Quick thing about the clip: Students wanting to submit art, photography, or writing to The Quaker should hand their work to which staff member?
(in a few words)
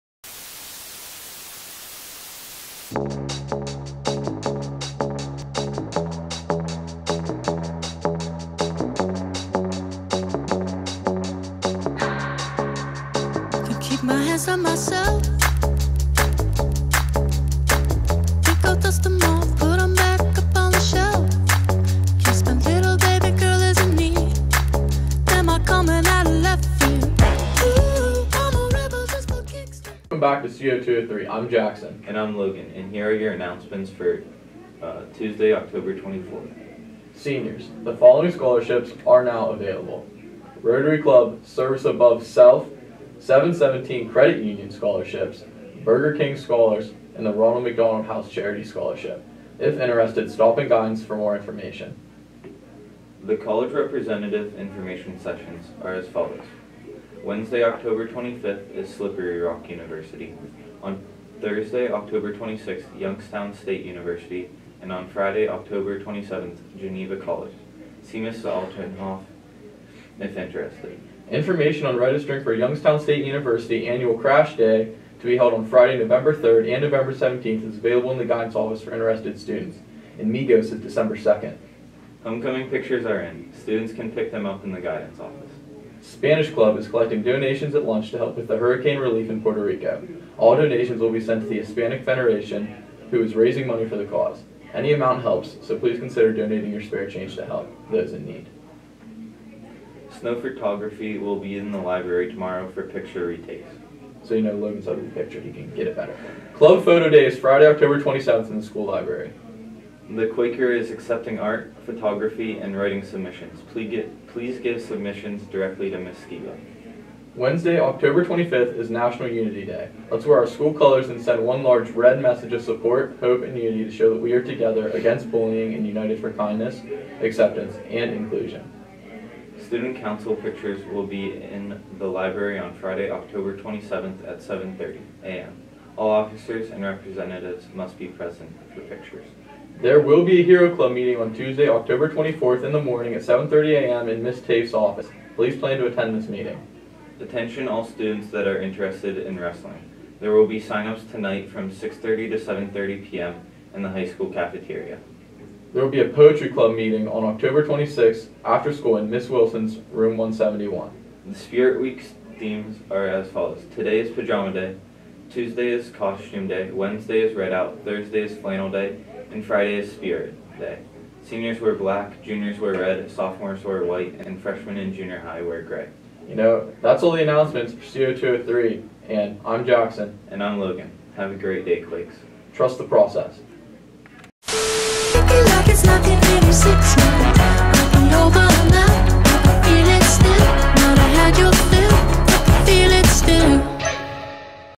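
Ms. Skiba.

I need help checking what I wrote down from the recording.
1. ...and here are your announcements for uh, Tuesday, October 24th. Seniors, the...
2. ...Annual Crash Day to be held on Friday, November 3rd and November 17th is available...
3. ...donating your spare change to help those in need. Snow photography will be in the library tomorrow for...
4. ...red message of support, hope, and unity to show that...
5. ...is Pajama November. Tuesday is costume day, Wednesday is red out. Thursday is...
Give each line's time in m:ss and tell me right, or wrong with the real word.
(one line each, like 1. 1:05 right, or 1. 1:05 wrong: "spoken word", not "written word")
1. 0:32 right
2. 1:13 right
3. 1:36 right
4. 2:01 right
5. 2:44 wrong: "Day", not "November".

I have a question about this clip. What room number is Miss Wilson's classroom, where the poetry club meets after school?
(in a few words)
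171.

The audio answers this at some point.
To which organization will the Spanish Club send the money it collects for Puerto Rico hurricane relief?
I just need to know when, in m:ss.
1:31.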